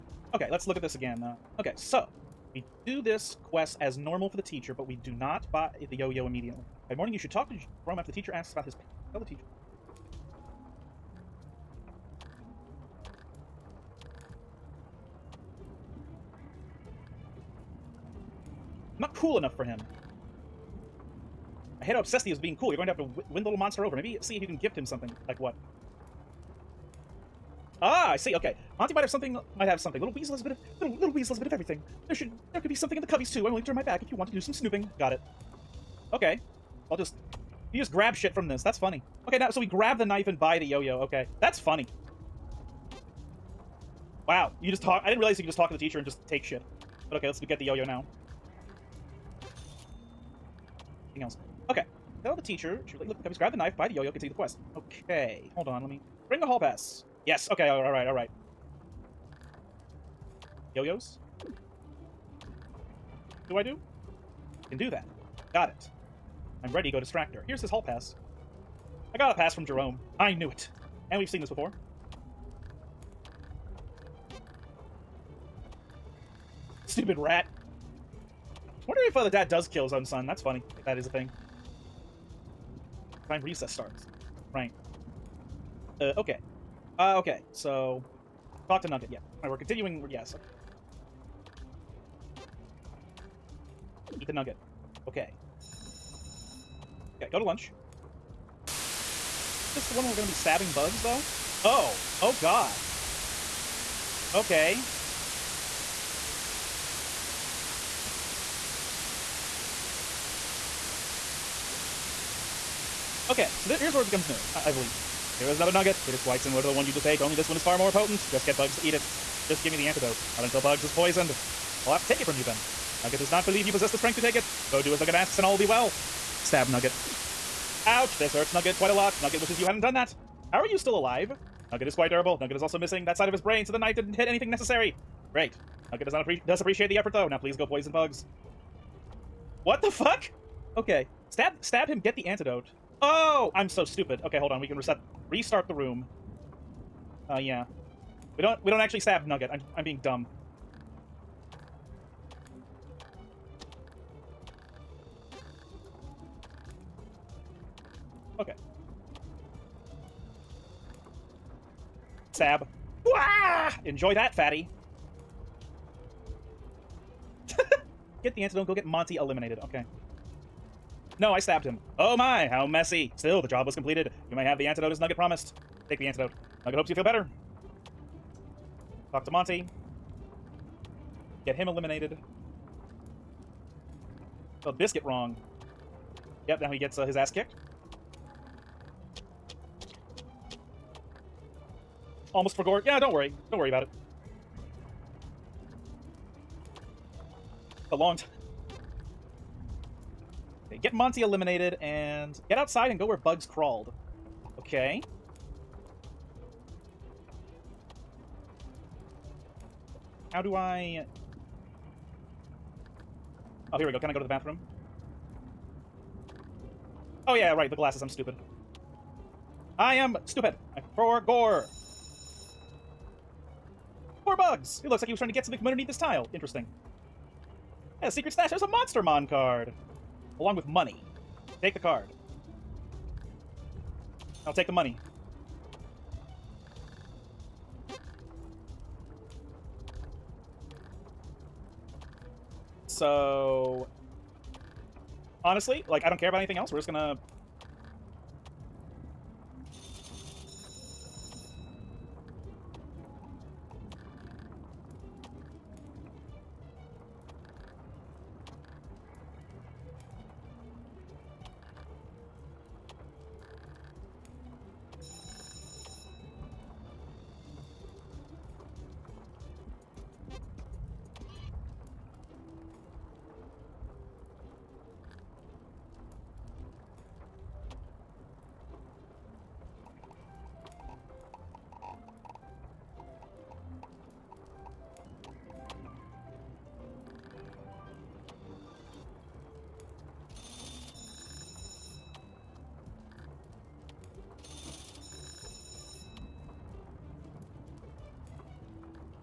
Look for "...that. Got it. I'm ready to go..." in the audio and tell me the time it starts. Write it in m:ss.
1:04.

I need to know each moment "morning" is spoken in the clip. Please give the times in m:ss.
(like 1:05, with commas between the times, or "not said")
0:06.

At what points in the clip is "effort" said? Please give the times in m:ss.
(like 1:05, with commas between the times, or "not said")
2:16.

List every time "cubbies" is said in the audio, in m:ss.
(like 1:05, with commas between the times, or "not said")
0:33, 0:53.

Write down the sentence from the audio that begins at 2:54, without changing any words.
You may have the antidote as Nugget promised.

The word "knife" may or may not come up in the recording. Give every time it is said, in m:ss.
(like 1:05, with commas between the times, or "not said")
0:40, 0:53, 2:13.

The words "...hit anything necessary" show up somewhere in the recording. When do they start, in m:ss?
2:14.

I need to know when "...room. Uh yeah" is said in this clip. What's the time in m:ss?
2:25.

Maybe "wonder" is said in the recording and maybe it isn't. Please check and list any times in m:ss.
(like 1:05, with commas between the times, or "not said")
1:18.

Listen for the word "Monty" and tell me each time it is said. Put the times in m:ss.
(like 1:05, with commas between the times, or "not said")
0:28, 2:48, 2:59, 3:20.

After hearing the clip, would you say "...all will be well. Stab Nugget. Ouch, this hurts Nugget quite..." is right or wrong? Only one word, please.
right.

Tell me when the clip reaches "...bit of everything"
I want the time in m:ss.
0:31.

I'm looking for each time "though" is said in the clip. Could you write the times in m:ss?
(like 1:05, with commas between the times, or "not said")
1:41, 2:17.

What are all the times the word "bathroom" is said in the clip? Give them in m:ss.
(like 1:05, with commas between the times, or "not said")
3:34.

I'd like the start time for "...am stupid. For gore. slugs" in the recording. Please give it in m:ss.
3:39.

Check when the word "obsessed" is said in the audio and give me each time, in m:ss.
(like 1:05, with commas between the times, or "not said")
0:21.